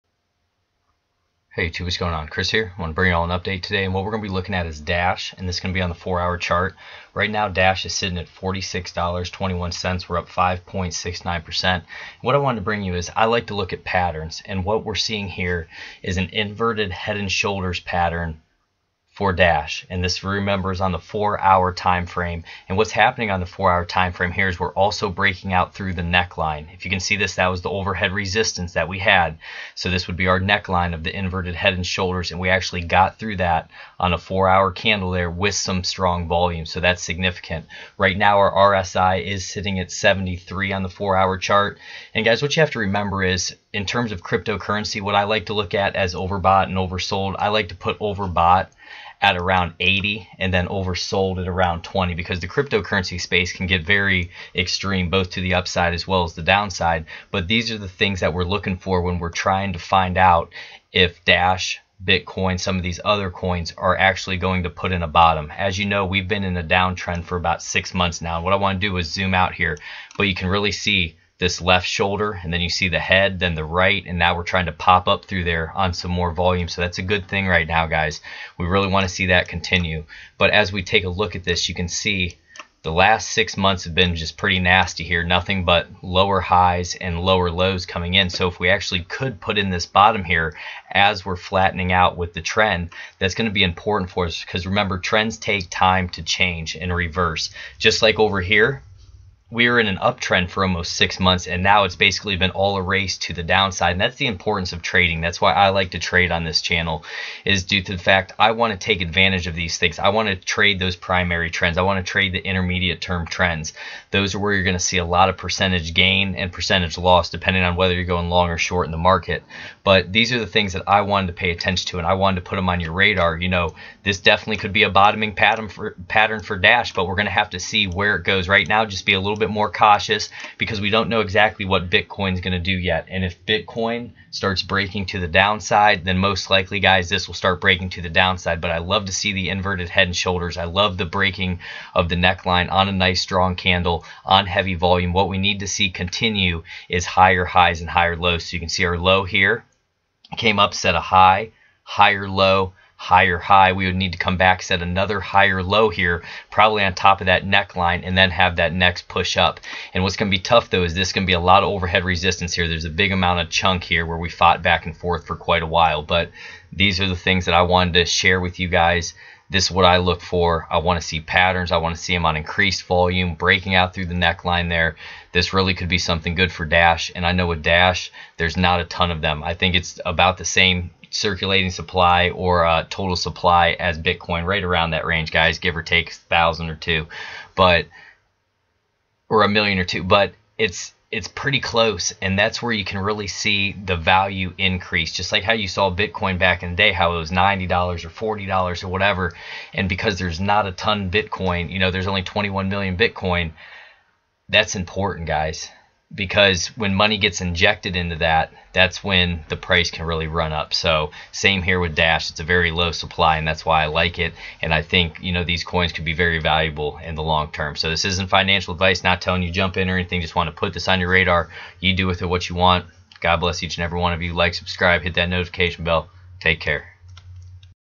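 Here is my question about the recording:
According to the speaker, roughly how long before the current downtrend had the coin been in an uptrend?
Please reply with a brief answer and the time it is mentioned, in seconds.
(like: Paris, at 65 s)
almost six months, at 100 s.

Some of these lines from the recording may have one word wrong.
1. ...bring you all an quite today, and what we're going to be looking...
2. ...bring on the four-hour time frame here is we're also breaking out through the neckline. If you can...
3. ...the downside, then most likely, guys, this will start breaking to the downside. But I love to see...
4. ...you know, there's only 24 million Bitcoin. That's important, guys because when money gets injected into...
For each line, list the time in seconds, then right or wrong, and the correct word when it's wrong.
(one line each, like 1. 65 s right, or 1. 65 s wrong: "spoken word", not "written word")
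1. 2 s wrong: "update", not "quite"
2. 22 s wrong: "happening", not "bring"
3. 135 s right
4. 201 s wrong: "21", not "24".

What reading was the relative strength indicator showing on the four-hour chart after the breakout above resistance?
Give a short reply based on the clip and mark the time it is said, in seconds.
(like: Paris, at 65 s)
73, at 39 s.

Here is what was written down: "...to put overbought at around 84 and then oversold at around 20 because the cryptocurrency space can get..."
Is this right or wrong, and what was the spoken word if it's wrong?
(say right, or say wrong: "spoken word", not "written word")
wrong: "80", not "84".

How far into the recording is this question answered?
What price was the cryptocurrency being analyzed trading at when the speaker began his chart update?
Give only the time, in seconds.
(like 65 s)
8 s.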